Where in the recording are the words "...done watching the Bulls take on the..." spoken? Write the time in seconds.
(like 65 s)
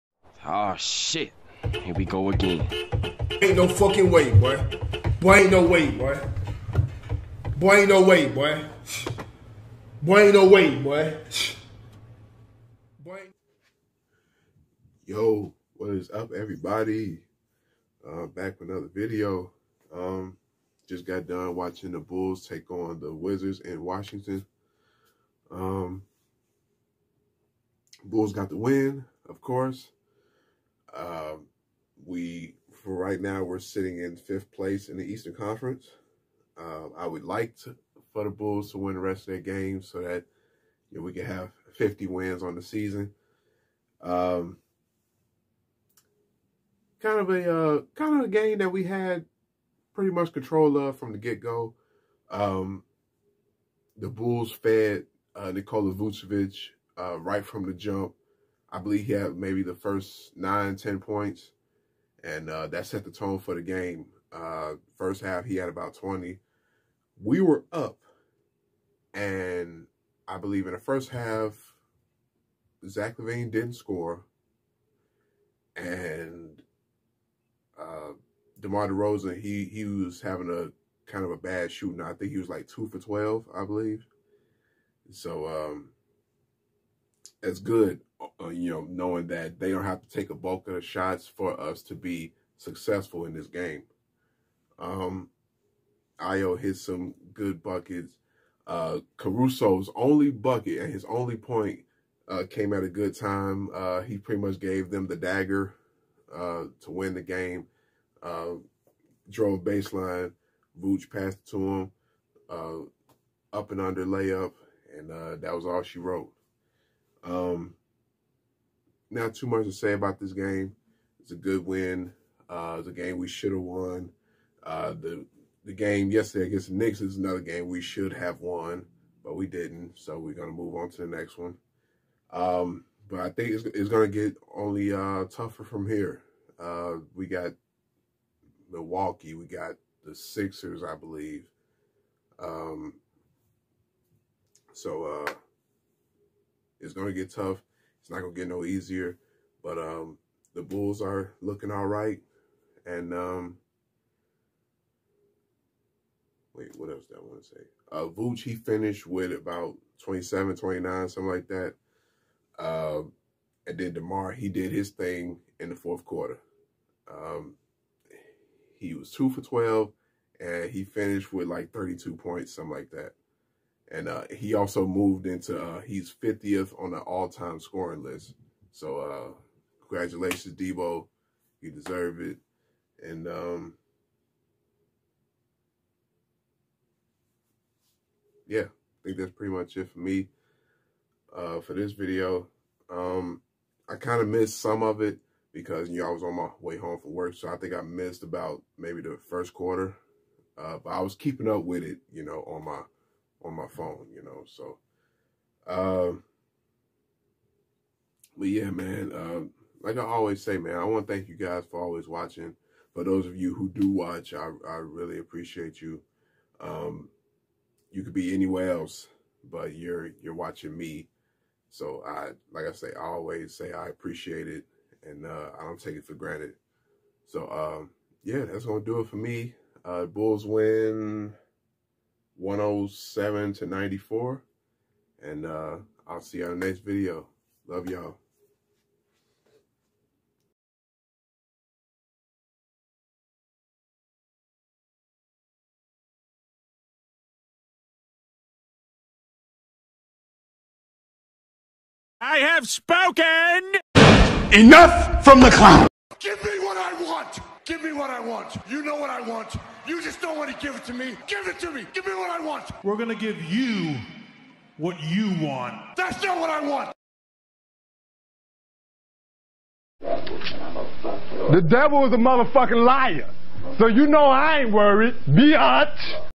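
21 s.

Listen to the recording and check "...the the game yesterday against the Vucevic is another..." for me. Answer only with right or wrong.
wrong.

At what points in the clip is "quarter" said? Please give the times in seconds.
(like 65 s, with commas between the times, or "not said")
166 s, 199 s.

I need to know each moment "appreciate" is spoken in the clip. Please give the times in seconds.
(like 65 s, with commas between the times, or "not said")
215 s, 223 s.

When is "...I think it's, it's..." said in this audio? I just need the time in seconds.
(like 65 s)
133 s.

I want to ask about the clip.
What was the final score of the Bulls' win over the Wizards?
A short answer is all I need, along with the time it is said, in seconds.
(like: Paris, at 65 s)
107 to 94, at 232 s.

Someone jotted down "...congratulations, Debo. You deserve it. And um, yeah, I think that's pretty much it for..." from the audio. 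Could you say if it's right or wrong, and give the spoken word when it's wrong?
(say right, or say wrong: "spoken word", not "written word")
right.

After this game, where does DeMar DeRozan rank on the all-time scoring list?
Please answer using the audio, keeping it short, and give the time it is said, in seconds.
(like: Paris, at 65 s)
50th, at 176 s.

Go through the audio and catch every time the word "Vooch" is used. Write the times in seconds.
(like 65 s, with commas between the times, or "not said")
110 s, 158 s.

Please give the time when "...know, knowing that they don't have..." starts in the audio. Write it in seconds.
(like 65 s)
88 s.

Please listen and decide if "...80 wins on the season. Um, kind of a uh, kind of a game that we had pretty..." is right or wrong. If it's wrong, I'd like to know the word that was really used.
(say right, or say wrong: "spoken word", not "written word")
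wrong: "50", not "80".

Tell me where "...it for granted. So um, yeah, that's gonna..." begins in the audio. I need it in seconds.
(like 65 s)
225 s.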